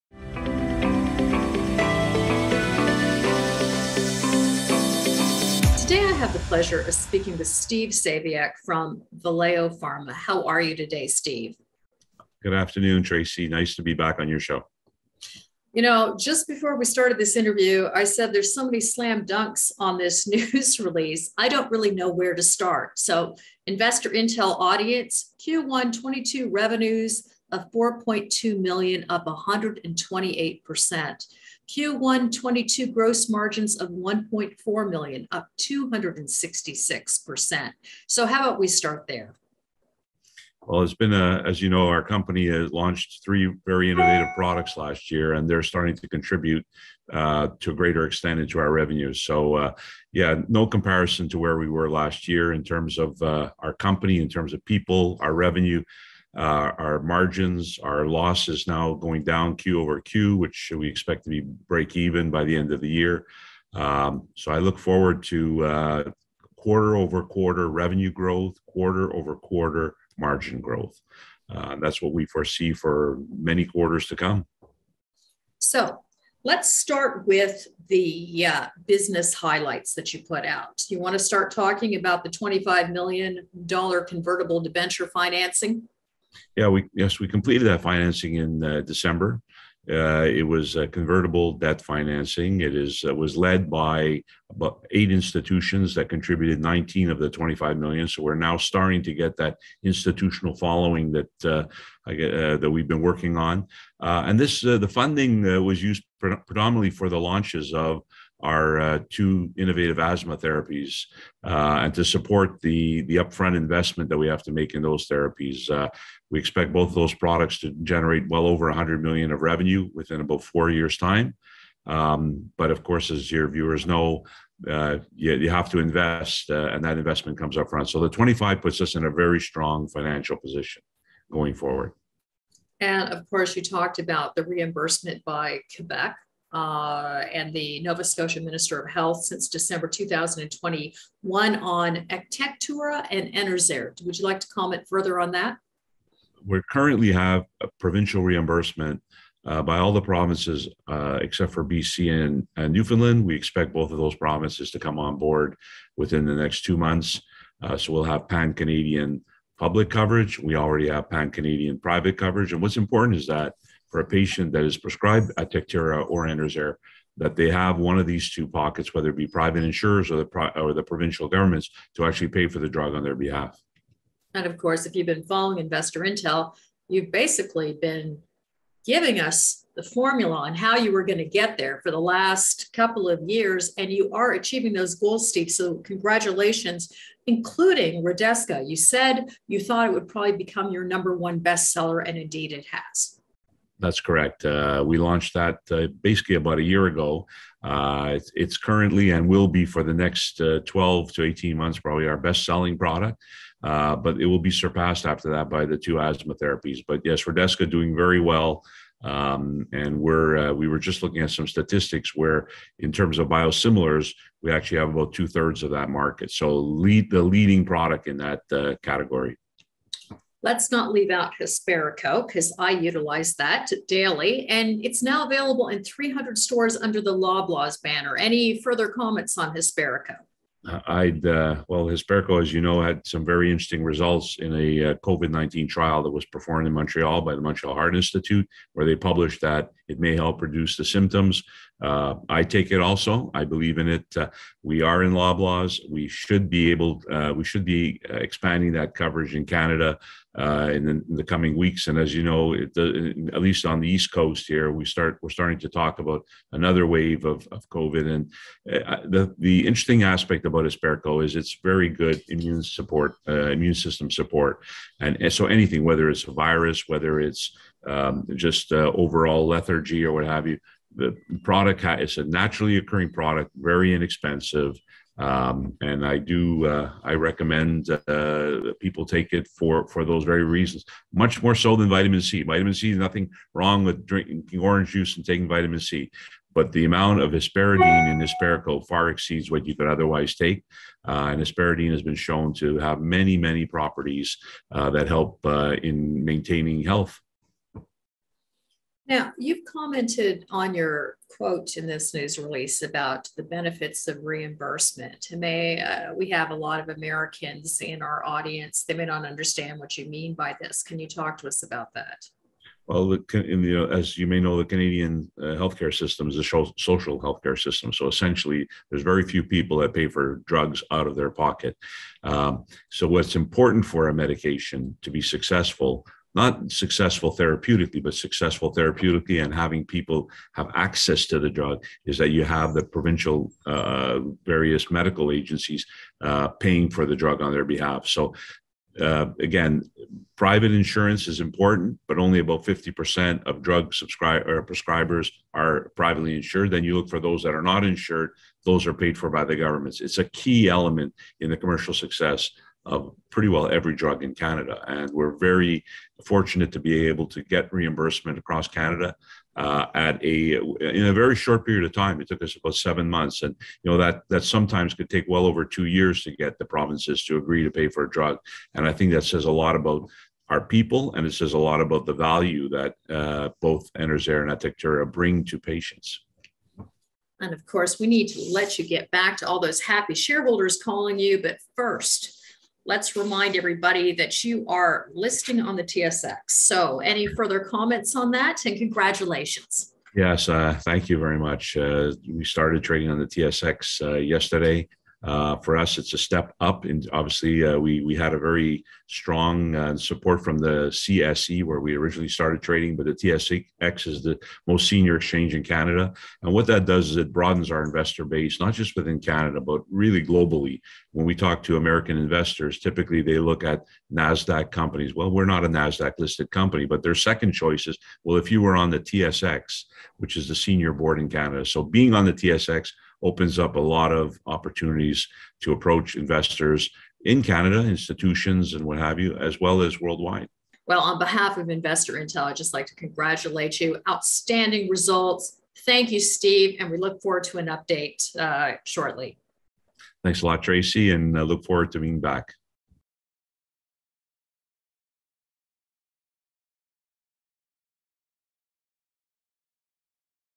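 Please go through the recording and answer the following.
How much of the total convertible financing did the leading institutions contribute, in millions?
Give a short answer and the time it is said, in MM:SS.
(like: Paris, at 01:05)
19 million, at 01:36.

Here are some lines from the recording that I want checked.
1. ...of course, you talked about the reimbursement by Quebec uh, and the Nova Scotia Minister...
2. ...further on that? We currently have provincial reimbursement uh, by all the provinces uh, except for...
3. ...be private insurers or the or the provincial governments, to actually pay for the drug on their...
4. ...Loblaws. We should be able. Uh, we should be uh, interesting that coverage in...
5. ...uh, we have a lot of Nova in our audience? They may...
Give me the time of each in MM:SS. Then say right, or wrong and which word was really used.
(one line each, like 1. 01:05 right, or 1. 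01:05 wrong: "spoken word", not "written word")
1. 02:13 right
2. 02:24 right
3. 02:49 right
4. 04:05 wrong: "expanding", not "interesting"
5. 05:05 wrong: "Americans", not "Nova".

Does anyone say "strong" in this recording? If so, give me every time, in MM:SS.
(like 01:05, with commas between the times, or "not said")
02:09, 06:39.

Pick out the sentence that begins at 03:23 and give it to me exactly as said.
Uh, but it will be surpassed after that by the two asthma therapies.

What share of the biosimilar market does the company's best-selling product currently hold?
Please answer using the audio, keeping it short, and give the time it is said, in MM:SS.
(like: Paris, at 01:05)
two thirds, at 03:35.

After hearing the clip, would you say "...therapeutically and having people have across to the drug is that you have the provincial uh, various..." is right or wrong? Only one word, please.
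wrong.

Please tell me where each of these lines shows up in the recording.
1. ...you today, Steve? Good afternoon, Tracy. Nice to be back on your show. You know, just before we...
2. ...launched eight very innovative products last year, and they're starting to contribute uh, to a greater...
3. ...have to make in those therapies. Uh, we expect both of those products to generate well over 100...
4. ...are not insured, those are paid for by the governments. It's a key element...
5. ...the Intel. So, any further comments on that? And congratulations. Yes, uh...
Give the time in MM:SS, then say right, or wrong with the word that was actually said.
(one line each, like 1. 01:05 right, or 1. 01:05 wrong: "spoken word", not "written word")
1. 00:10 right
2. 00:42 wrong: "three", not "eight"
3. 01:54 right
4. 05:47 right
5. 06:25 wrong: "TSX", not "Intel".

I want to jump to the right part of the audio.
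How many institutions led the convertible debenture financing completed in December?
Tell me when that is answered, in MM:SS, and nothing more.
01:34.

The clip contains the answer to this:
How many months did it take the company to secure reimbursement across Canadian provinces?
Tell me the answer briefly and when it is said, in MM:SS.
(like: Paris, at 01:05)
7 months, at 06:02.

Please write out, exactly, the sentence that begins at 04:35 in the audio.
Um, and I do uh, I recommend uh, people take it for for those very reasons.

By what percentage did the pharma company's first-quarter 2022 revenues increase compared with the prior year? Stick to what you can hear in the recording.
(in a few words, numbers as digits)
128%.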